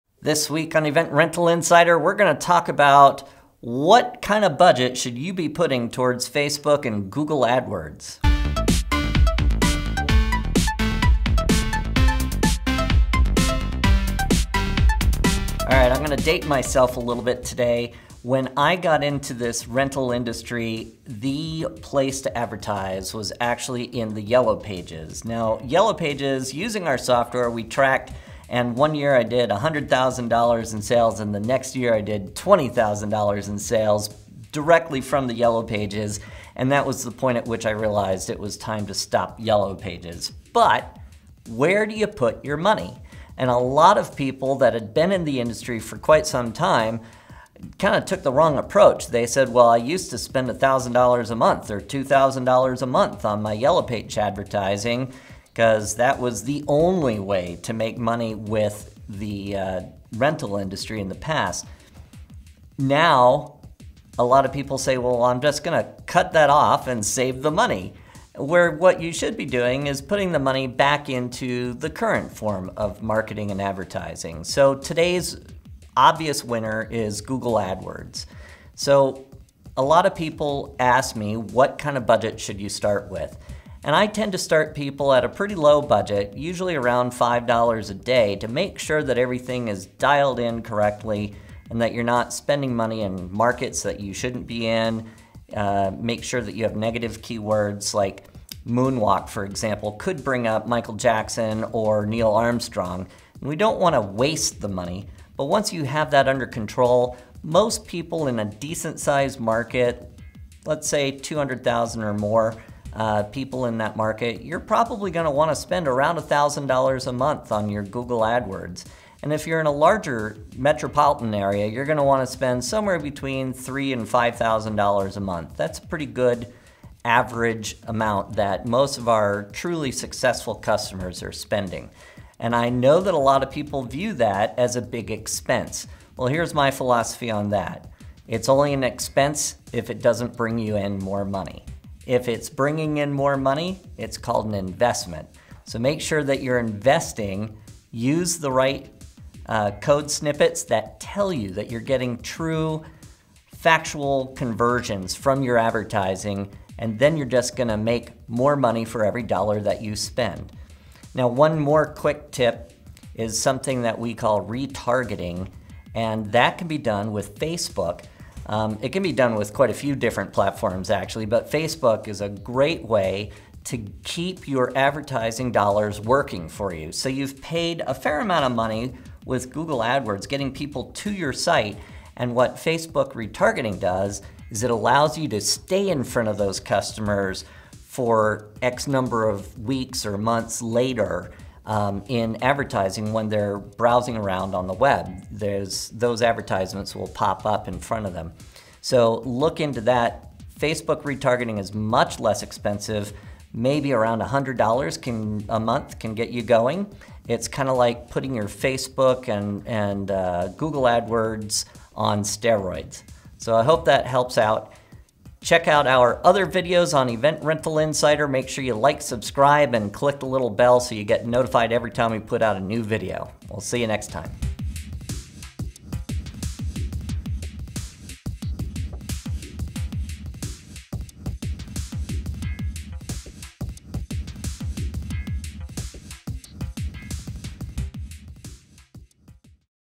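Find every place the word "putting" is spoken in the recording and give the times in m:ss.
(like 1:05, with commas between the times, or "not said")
0:05, 1:10, 3:28.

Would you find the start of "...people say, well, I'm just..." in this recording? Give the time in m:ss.
1:04.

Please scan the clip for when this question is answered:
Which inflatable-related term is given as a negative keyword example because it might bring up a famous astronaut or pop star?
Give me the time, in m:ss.
1:38.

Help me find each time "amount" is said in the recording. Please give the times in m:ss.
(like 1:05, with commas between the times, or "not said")
2:07, 2:58.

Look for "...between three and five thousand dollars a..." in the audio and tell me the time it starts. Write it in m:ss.
2:02.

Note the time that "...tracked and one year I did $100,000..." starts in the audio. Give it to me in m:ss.
0:27.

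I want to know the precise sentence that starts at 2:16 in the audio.
Well, here's my philosophy on that.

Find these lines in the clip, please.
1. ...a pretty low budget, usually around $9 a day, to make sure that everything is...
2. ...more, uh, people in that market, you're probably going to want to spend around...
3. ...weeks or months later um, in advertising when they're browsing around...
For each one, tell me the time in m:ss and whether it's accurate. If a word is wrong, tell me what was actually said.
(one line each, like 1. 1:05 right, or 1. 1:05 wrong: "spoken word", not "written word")
1. 1:25 wrong: "5", not "9"
2. 1:52 right
3. 3:09 right.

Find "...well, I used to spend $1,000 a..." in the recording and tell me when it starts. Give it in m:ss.
0:49.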